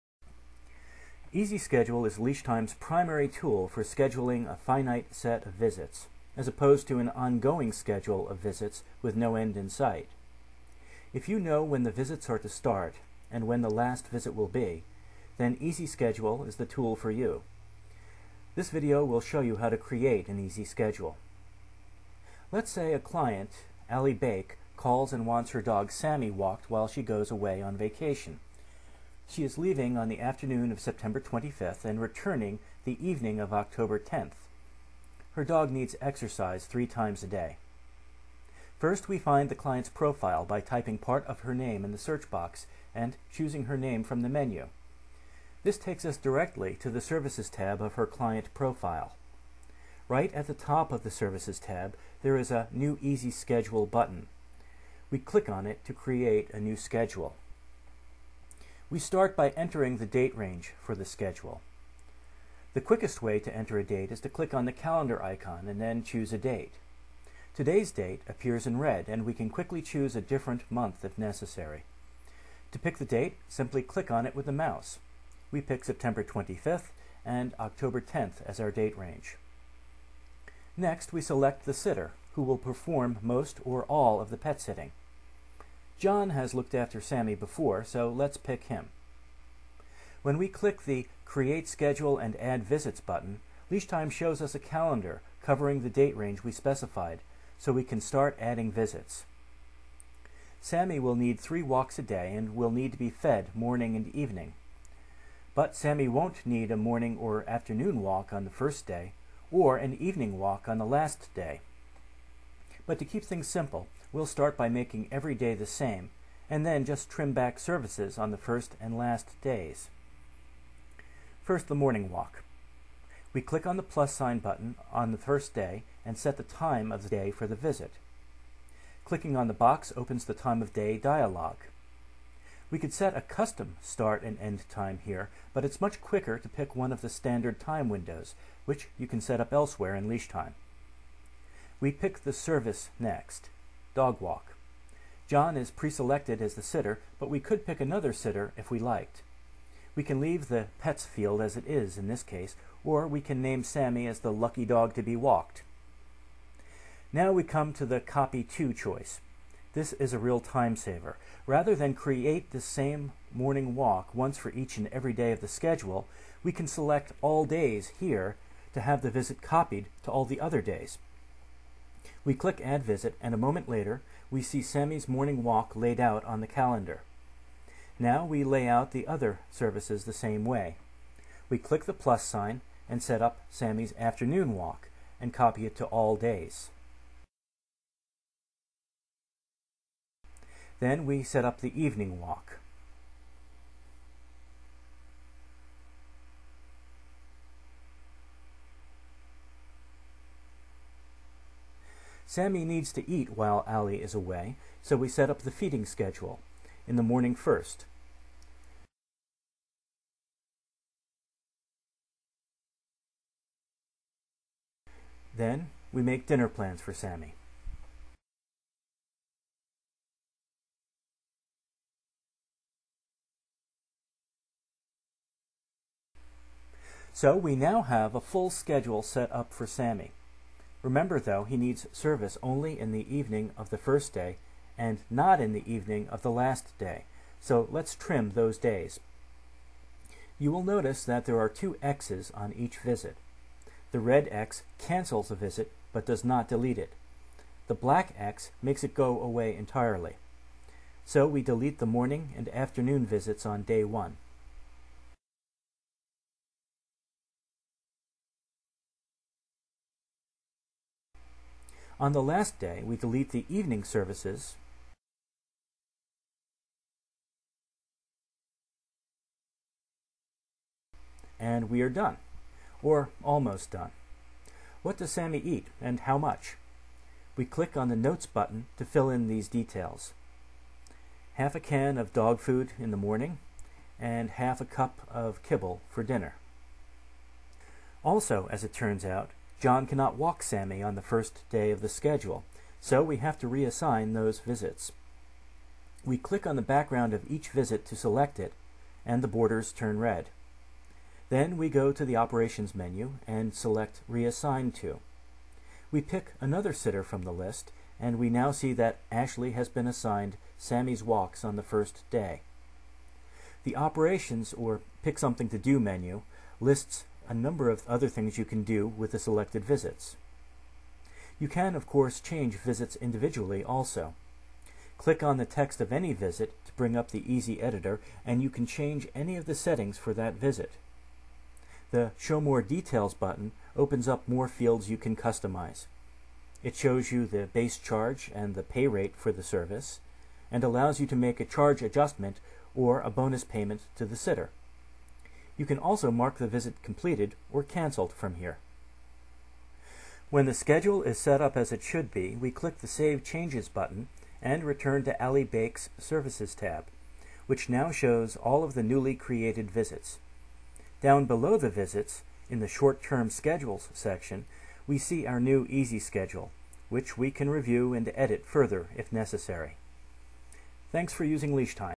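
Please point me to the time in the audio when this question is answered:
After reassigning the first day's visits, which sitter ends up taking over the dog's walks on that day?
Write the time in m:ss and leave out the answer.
5:09.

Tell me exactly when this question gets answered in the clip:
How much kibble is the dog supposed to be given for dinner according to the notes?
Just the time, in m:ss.
4:44.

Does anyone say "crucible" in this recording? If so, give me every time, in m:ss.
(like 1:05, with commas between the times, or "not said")
not said.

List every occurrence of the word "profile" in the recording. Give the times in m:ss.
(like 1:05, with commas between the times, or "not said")
0:39, 0:48.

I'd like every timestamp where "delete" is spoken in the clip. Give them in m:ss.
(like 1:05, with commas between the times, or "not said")
4:06, 4:11, 4:22.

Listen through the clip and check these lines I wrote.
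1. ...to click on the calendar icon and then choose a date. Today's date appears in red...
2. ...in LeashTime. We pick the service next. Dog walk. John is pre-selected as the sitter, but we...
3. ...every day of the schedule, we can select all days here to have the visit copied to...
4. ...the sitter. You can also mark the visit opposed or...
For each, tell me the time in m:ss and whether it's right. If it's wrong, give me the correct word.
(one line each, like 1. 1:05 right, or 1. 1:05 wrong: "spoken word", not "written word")
1. 1:04 right
2. 2:19 right
3. 2:44 right
4. 5:44 wrong: "completed", not "opposed".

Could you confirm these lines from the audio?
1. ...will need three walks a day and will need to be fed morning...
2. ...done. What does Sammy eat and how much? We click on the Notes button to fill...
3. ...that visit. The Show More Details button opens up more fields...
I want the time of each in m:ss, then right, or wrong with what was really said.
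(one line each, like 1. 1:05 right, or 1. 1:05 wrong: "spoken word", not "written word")
1. 1:40 right
2. 4:33 right
3. 5:30 right.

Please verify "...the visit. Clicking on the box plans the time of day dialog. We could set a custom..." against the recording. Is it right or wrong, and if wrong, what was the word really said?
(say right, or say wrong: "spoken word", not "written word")
wrong: "opens", not "plans".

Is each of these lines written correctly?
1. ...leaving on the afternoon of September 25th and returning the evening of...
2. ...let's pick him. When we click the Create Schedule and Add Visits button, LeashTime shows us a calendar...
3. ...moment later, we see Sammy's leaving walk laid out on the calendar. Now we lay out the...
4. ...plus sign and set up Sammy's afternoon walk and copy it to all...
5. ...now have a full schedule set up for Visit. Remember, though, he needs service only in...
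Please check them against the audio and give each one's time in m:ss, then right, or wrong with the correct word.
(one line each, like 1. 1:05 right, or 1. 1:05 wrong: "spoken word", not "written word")
1. 0:29 right
2. 1:28 right
3. 2:53 wrong: "morning", not "leaving"
4. 3:01 right
5. 3:47 wrong: "Sammy", not "Visit".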